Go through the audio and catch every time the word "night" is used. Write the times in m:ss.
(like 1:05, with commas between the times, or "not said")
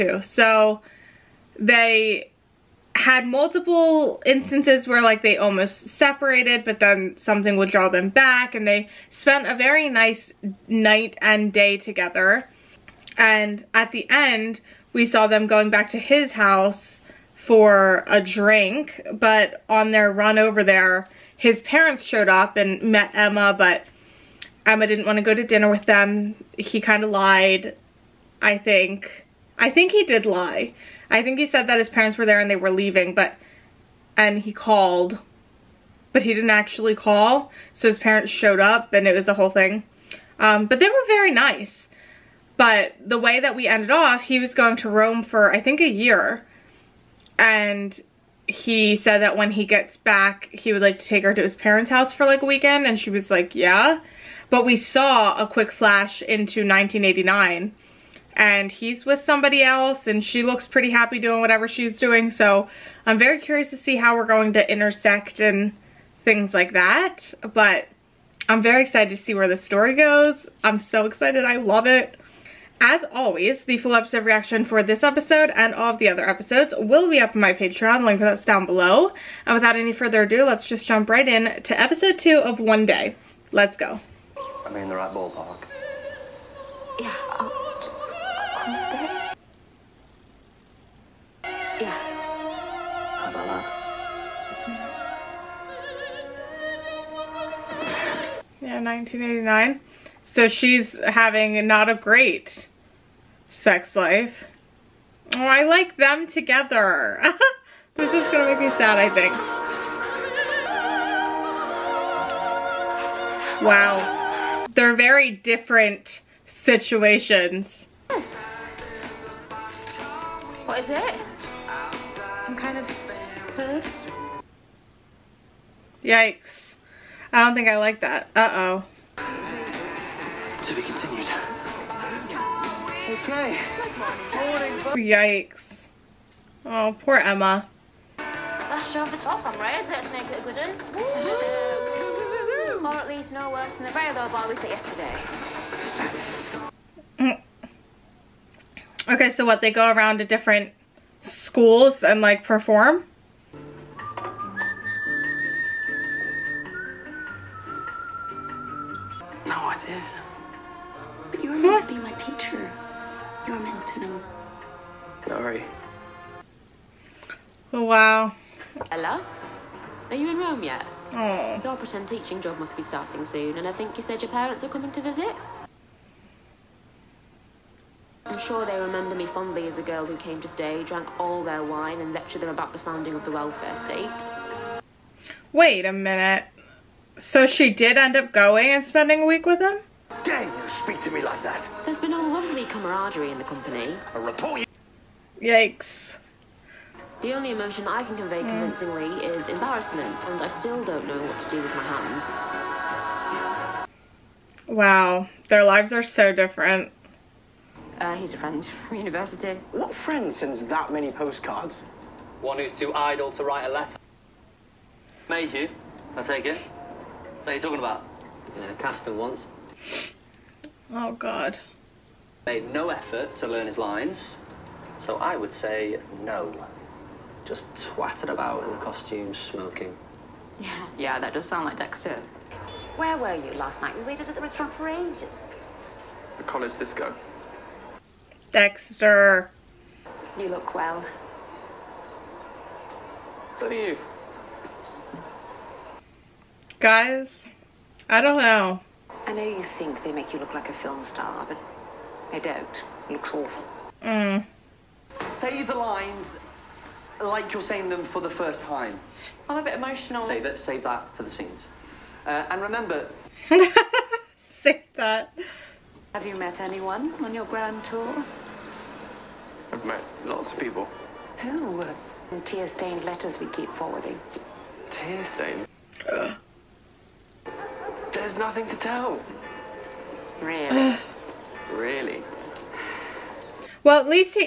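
0:10, 3:53.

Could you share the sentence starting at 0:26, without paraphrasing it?
He kind of lied, I think.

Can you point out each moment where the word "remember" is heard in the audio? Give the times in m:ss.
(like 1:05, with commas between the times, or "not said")
2:58, 4:22.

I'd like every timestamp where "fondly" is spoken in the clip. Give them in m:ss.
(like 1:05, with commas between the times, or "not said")
2:59.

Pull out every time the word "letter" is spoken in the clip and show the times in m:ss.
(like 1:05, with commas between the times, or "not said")
3:33, 4:33.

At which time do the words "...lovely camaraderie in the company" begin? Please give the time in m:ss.
3:12.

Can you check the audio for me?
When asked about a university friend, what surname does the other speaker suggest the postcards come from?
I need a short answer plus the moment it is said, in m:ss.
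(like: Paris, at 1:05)
Mayhew, at 3:35.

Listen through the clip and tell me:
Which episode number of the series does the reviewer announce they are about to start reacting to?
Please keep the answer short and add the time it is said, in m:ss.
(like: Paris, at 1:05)
Episode 2, at 1:21.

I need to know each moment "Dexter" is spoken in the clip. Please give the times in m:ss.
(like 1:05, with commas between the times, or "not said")
3:51, 3:58.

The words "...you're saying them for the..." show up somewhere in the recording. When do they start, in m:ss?
4:17.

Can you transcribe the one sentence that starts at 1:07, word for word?
But I'm very excited to see where the story goes.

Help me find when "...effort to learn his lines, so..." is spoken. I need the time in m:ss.
3:42.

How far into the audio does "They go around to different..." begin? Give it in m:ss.
2:29.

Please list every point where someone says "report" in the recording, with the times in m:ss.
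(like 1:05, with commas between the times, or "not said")
3:14.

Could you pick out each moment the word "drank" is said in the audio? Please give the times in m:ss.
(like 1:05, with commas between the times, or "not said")
3:00.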